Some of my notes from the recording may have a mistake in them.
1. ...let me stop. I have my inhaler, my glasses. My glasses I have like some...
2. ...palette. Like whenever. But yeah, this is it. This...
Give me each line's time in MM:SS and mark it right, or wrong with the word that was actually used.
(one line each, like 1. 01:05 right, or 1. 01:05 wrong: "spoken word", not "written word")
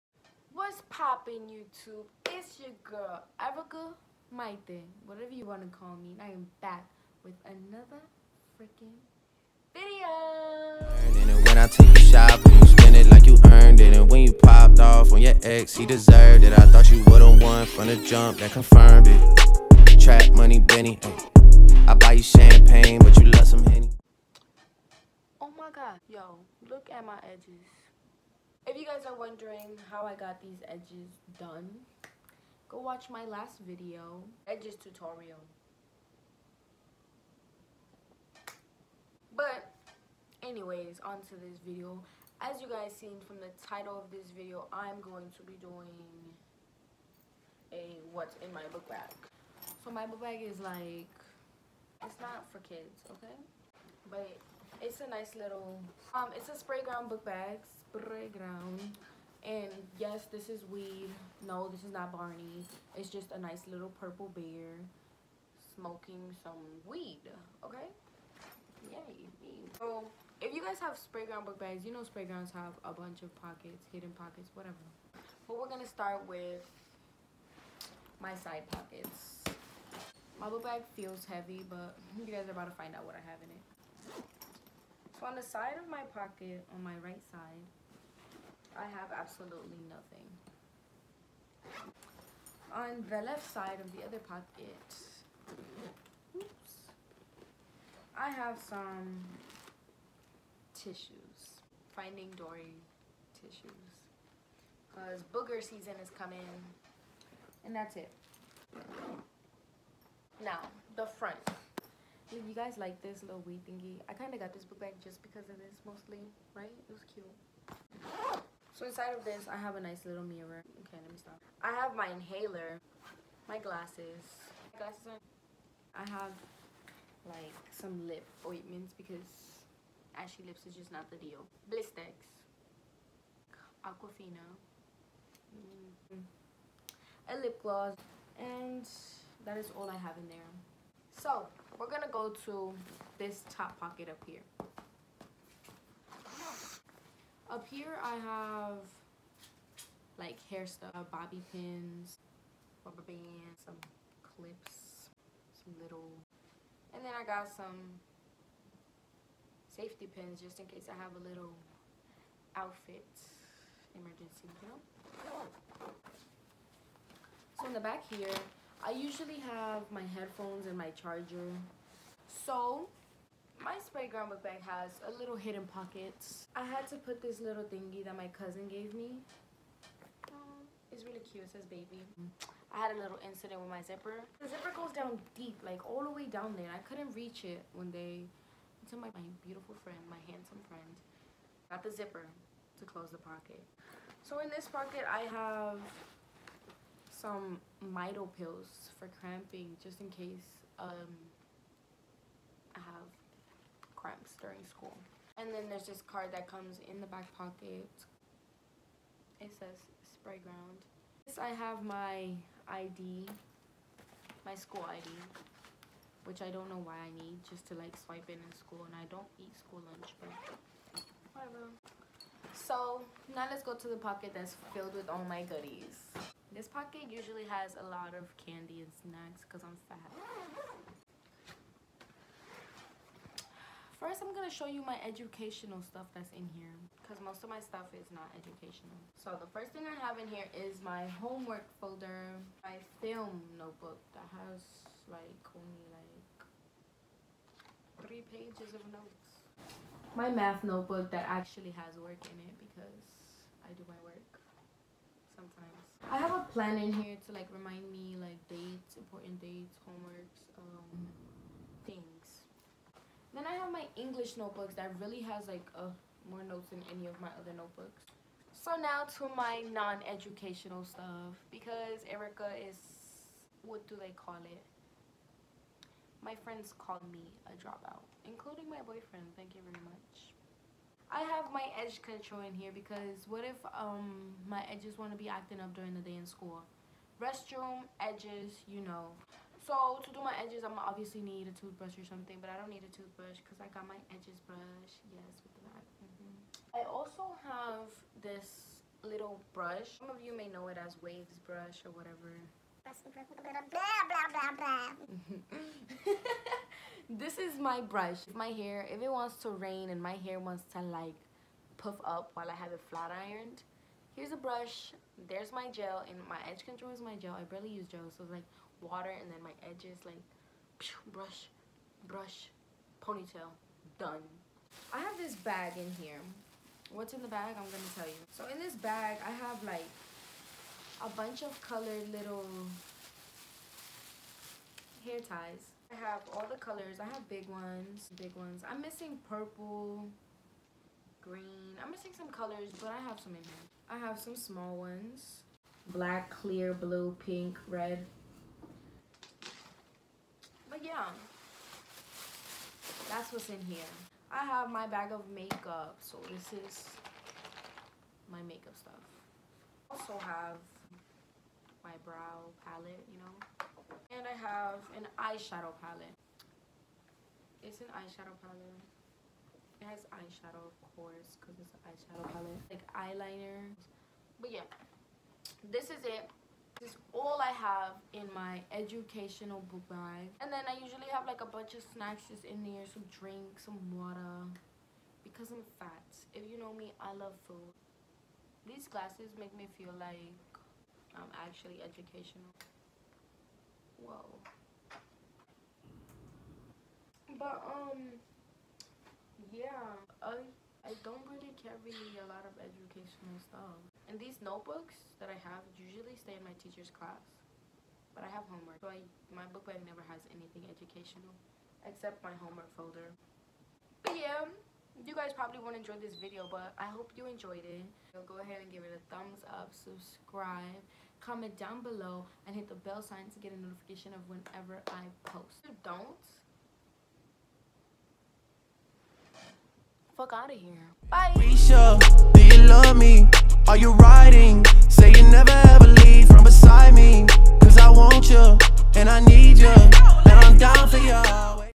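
1. 02:01 right
2. 06:12 wrong: "eyeliner", not "whenever".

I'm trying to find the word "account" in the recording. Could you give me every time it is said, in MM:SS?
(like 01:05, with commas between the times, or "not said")
not said.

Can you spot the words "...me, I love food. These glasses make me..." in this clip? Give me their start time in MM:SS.
06:26.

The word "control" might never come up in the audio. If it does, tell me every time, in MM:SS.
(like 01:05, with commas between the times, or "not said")
04:42, 05:16.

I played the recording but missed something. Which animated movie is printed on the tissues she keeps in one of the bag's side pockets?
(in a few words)
Finding Dory.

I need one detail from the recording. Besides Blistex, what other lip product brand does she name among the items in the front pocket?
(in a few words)
Aquaphor.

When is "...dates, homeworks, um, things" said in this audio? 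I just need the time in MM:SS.
04:19.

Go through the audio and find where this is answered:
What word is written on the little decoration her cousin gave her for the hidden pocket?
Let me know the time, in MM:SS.
03:01.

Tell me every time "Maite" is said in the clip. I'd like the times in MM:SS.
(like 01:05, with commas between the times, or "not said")
00:04.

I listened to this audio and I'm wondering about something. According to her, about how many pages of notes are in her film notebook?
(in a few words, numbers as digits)
3.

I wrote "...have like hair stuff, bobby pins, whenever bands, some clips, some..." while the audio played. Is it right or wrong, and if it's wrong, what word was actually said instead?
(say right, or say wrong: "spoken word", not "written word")
wrong: "rubber", not "whenever".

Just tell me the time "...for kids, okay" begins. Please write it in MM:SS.
00:52.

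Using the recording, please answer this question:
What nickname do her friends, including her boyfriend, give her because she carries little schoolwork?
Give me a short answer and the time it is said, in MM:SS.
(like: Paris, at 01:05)
dropout, at 04:37.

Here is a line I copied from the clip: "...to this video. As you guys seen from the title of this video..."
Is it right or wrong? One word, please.
right.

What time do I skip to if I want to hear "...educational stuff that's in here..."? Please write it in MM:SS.
03:55.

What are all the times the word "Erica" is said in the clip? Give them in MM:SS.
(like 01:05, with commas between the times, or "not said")
00:03, 04:32.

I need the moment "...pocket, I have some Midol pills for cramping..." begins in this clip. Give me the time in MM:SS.
03:14.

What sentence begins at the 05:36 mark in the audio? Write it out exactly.
I have big ones, big ones.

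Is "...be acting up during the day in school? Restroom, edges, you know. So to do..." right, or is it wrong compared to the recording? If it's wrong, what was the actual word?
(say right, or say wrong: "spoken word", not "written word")
right.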